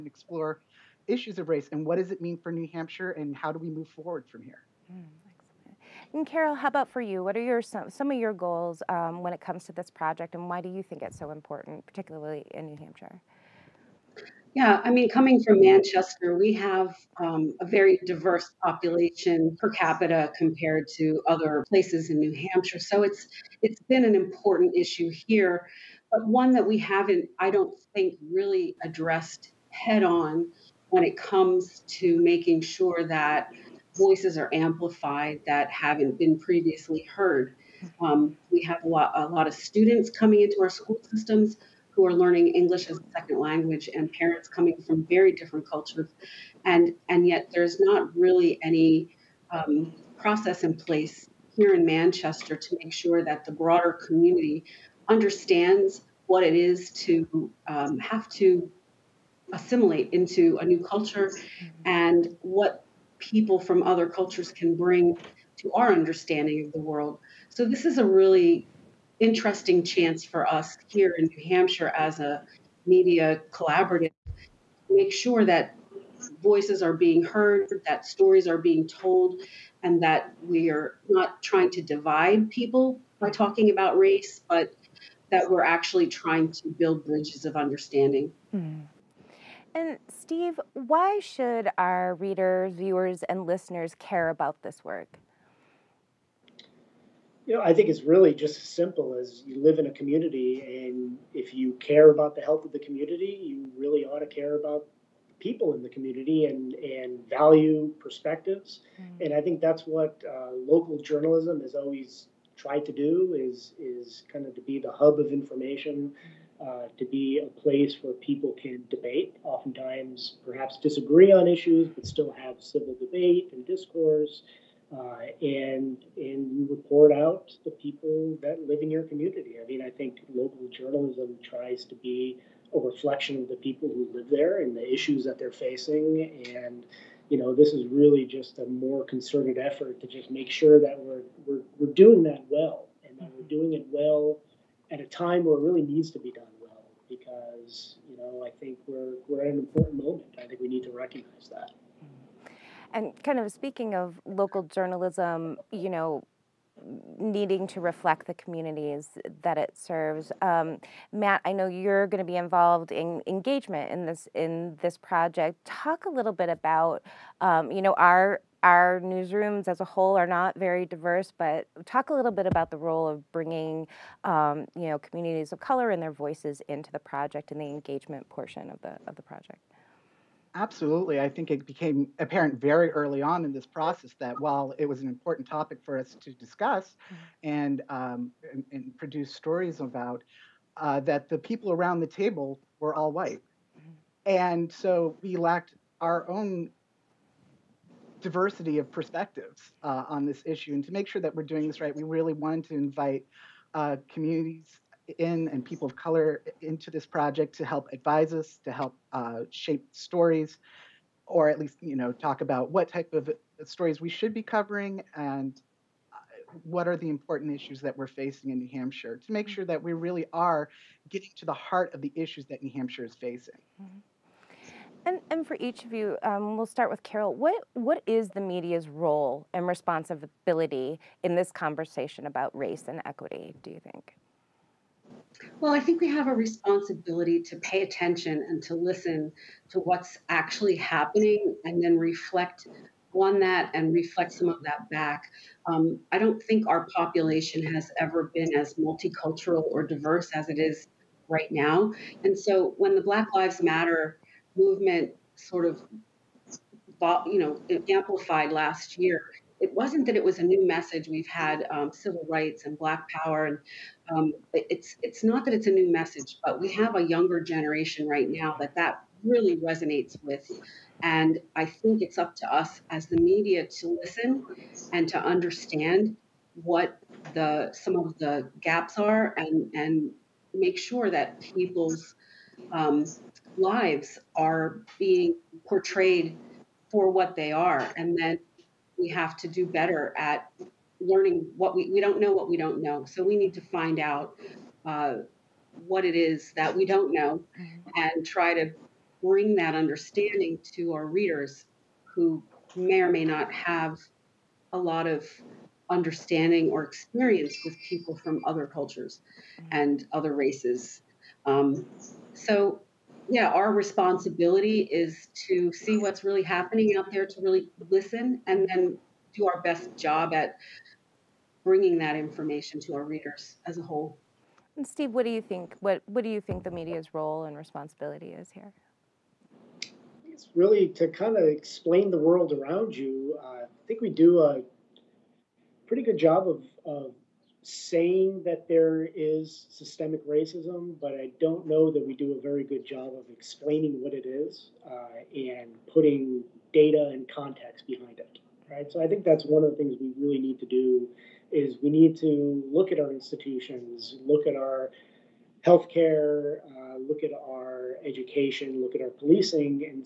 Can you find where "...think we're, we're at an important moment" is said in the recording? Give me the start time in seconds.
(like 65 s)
148 s.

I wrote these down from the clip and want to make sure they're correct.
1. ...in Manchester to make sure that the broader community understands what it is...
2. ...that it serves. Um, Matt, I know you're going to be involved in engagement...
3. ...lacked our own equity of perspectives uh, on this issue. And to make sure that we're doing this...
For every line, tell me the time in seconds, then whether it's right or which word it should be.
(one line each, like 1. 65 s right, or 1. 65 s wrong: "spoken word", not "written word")
1. 51 s right
2. 159 s right
3. 195 s wrong: "diversity", not "equity".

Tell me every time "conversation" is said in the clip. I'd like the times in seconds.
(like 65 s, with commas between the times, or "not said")
231 s.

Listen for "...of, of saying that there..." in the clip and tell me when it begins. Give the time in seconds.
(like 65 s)
336 s.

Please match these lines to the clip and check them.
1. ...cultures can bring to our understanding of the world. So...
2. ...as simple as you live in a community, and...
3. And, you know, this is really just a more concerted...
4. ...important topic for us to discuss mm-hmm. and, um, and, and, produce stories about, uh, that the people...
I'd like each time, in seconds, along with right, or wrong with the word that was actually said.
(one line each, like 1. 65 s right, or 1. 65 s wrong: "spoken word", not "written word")
1. 64 s right
2. 98 s right
3. 136 s right
4. 185 s right.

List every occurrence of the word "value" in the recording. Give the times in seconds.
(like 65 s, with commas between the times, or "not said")
107 s.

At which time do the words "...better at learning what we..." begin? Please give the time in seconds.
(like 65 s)
289 s.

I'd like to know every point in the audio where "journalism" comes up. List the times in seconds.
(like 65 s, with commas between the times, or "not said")
110 s, 130 s, 154 s.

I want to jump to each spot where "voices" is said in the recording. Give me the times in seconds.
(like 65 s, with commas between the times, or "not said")
33 s, 76 s, 176 s.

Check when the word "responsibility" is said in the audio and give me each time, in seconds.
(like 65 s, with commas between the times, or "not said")
229 s, 236 s, 313 s, 327 s.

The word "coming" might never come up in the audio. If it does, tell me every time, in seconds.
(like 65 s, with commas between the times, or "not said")
15 s, 40 s, 44 s.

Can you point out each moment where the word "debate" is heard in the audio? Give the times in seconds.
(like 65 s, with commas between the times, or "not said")
118 s, 122 s.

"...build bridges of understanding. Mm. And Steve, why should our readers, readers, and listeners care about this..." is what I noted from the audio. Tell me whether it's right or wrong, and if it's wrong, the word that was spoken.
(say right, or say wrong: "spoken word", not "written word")
wrong: "viewers", not "readers".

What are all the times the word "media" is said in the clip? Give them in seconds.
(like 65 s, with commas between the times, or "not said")
72 s, 228 s, 273 s, 326 s.